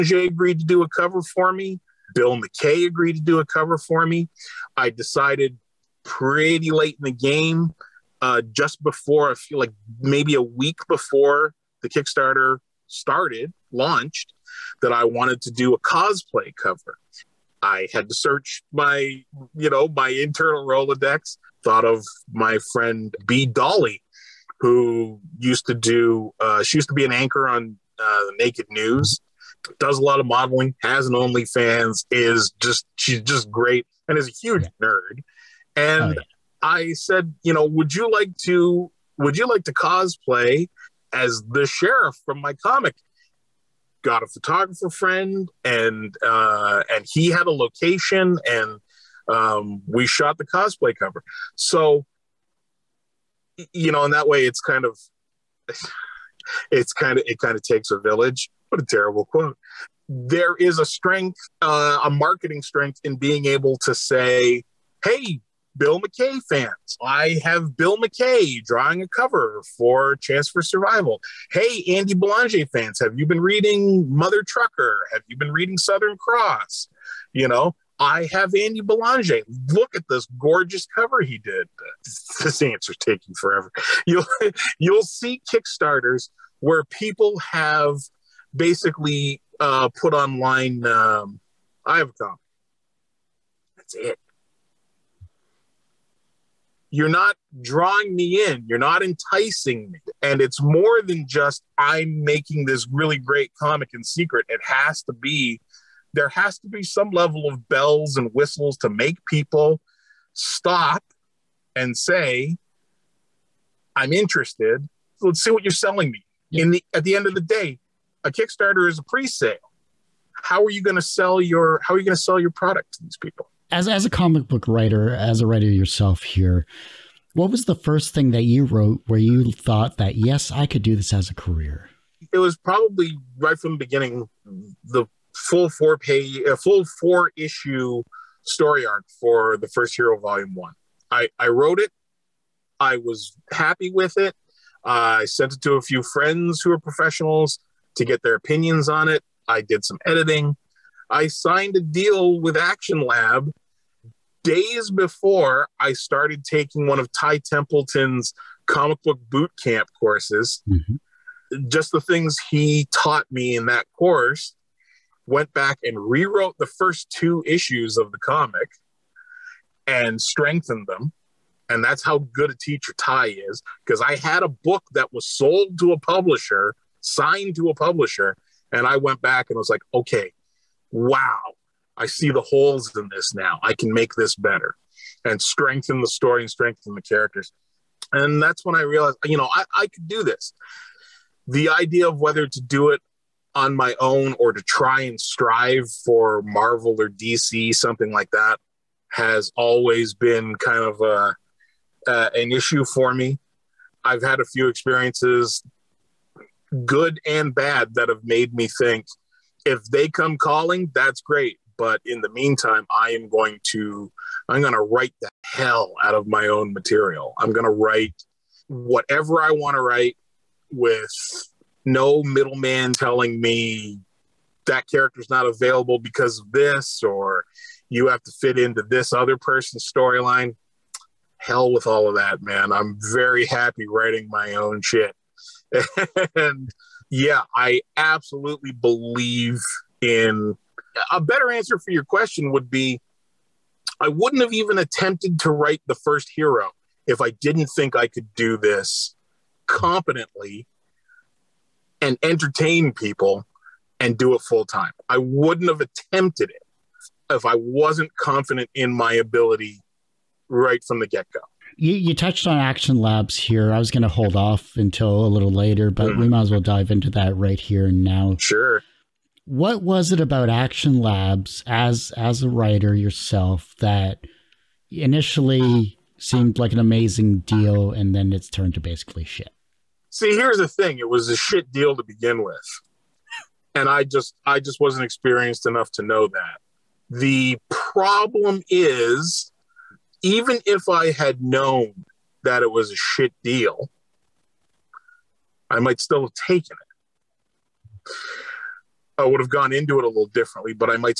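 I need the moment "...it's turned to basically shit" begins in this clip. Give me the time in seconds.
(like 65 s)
278 s.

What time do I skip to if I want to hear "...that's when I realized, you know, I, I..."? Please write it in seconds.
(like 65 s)
188 s.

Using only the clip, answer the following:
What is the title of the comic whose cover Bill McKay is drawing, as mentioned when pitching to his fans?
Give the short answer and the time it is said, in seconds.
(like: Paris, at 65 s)
Chance for Survival, at 70 s.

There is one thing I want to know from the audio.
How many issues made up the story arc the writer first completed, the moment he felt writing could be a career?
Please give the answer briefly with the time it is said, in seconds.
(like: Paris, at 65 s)
4, at 137 s.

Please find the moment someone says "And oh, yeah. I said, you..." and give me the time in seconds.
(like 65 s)
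35 s.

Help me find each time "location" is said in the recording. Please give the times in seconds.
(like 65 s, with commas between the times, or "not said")
47 s.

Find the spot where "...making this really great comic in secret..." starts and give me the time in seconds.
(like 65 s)
102 s.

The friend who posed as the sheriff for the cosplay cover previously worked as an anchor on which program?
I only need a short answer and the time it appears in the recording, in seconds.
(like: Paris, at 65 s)
Naked News, at 28 s.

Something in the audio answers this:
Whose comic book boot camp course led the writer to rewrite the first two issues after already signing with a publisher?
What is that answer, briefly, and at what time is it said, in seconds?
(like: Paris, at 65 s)
Ty Templeton, at 157 s.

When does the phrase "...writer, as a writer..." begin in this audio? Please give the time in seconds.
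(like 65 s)
124 s.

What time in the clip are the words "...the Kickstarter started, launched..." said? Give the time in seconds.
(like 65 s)
11 s.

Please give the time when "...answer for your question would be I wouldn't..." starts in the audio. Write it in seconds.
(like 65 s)
241 s.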